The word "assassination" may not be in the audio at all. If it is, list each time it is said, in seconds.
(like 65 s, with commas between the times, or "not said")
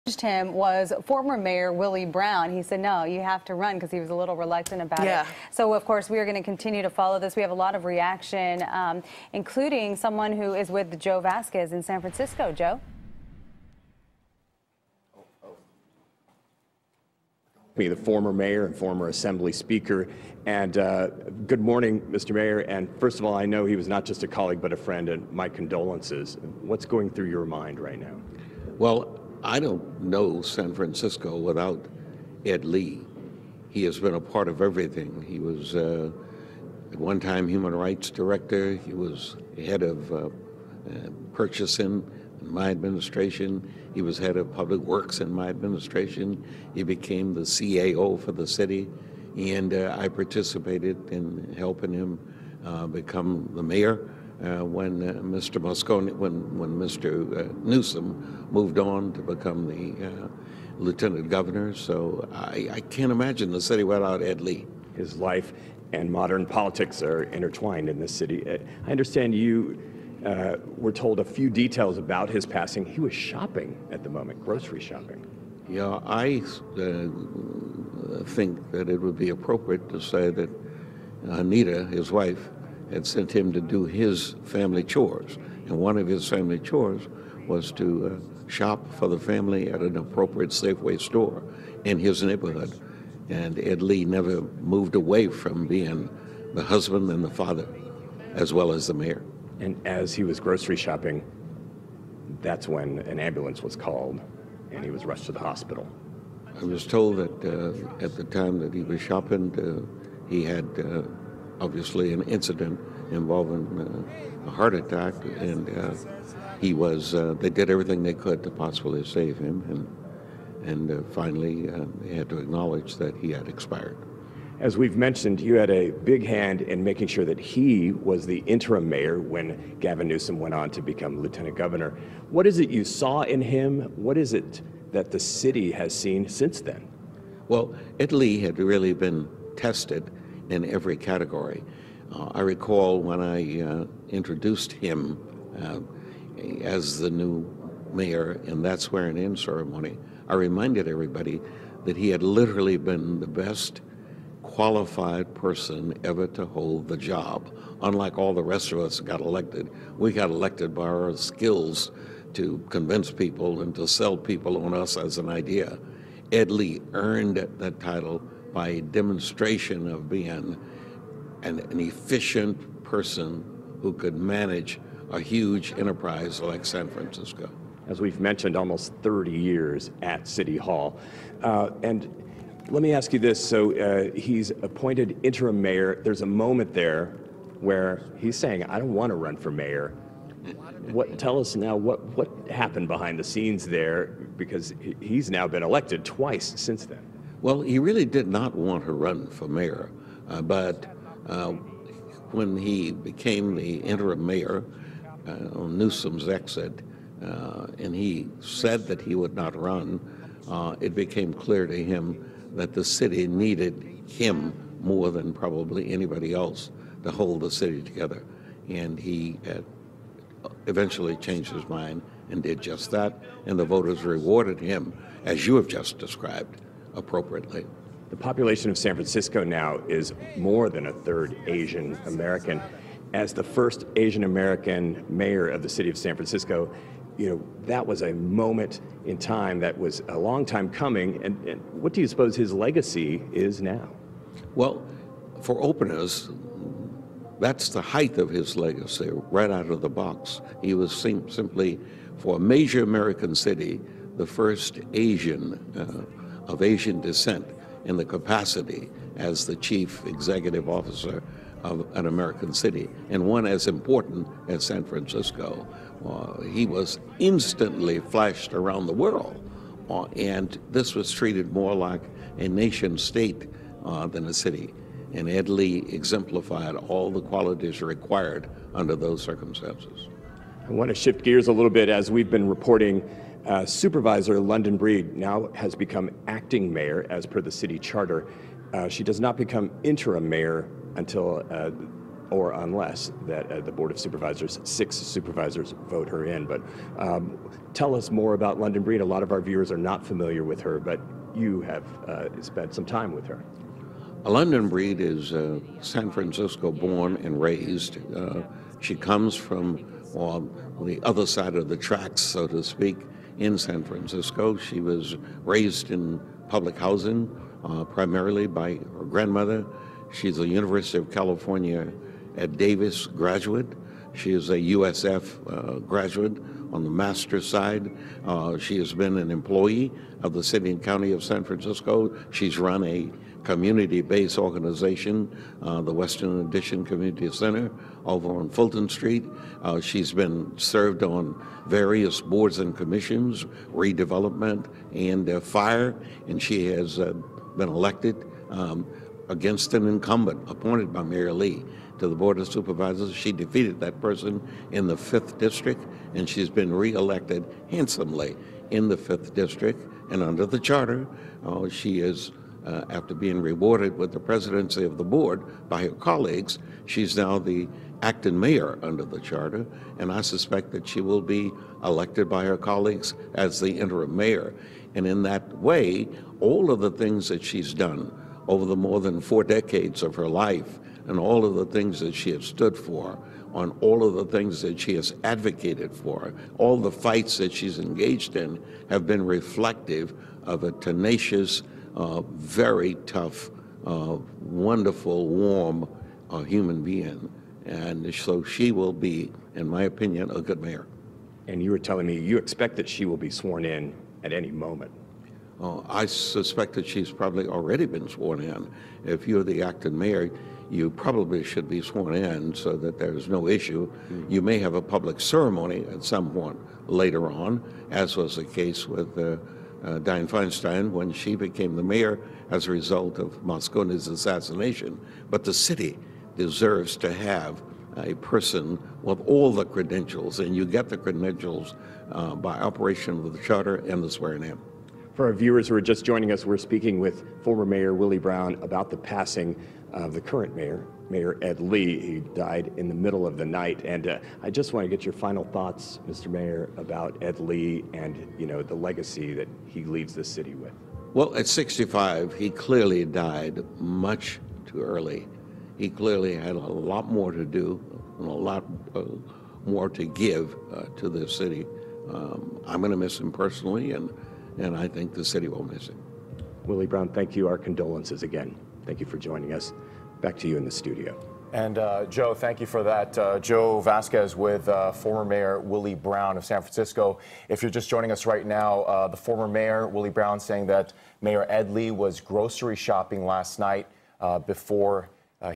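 424 s.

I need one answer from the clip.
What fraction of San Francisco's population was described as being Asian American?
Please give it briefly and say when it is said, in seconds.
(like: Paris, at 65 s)
more than a third, at 230 s.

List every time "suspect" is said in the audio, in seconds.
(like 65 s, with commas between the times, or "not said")
370 s, 406 s.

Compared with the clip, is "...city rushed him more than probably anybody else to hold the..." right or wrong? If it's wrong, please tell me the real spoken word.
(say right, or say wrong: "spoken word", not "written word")
wrong: "needed", not "rushed".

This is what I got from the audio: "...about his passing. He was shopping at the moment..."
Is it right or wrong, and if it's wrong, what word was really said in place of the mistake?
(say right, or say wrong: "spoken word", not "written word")
right.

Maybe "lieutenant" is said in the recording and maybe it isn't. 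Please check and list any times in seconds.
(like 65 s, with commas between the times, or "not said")
60 s, 131 s.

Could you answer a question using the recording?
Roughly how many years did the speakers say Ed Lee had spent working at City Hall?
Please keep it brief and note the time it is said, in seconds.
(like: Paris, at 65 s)
30, at 179 s.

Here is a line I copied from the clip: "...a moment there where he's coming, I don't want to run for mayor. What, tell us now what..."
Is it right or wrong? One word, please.
wrong.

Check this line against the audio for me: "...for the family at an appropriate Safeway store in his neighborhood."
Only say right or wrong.
right.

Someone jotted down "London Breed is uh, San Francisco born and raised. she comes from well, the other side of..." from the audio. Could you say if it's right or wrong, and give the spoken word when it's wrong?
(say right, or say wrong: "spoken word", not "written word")
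right.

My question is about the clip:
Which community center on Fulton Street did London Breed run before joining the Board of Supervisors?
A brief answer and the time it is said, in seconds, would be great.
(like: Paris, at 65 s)
Western Addition Community Center, at 335 s.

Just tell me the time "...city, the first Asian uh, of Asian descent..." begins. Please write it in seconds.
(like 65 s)
253 s.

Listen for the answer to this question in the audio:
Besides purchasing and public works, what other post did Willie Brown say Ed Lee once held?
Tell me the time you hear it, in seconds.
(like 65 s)
37 s.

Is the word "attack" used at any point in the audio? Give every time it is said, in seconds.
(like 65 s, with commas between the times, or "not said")
114 s.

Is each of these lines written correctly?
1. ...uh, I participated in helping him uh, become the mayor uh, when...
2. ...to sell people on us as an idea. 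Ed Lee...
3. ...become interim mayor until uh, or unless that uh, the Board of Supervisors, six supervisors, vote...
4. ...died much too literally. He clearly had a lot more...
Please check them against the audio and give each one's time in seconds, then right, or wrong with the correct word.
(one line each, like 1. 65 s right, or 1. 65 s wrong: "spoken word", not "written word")
1. 49 s right
2. 163 s right
3. 289 s right
4. 453 s wrong: "early", not "literally".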